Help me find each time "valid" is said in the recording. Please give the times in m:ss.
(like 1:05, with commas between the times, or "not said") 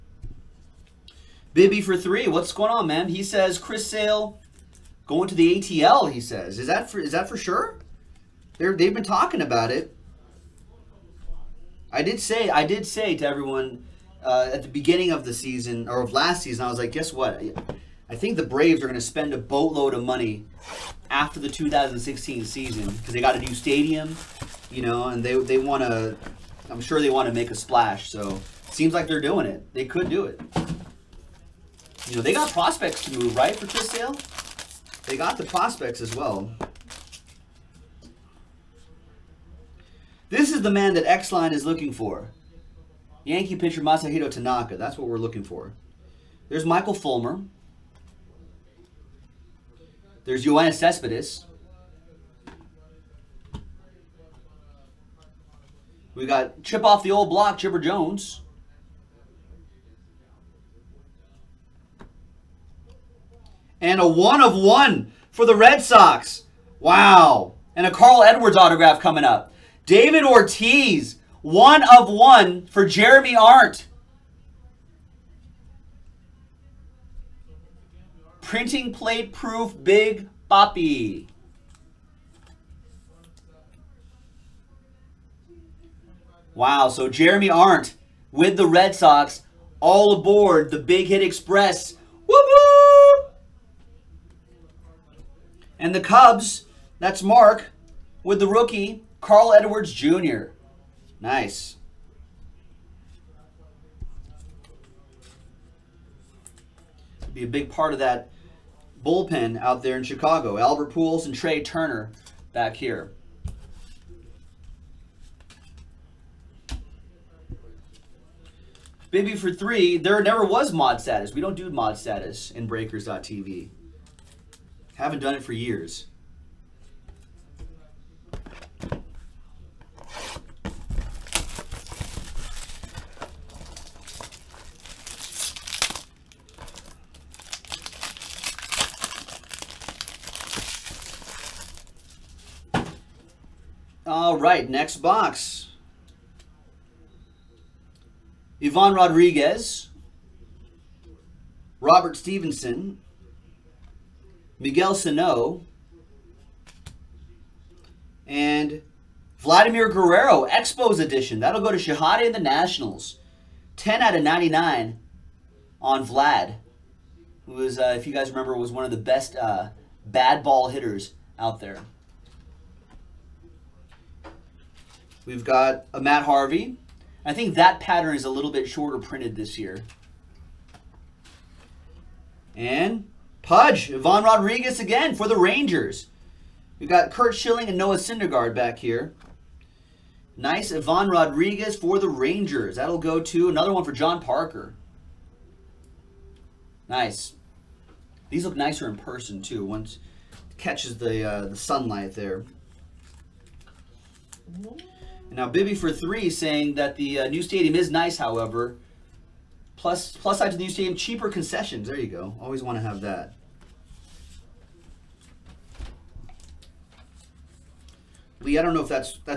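not said.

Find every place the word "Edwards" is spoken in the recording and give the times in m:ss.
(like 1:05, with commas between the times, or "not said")
1:08, 1:39.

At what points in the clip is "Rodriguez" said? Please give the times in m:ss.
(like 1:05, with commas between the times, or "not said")
2:28, 3:04, 3:11.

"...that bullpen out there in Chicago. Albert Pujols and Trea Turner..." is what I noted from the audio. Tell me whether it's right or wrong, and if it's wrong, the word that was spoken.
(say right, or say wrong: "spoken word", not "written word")
right.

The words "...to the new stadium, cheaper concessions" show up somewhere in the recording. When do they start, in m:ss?
3:30.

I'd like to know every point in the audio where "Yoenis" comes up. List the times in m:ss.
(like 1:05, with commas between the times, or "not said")
0:50.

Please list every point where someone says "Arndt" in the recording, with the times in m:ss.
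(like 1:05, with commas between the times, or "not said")
1:13, 1:27.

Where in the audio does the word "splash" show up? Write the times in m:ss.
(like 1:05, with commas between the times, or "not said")
0:27.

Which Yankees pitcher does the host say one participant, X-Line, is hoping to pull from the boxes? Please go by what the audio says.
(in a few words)
Masahiro Tanaka.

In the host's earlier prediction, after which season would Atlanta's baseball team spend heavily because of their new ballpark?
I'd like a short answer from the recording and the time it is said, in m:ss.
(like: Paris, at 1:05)
2016, at 0:21.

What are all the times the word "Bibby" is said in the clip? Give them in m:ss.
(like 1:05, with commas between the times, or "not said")
0:01, 3:25.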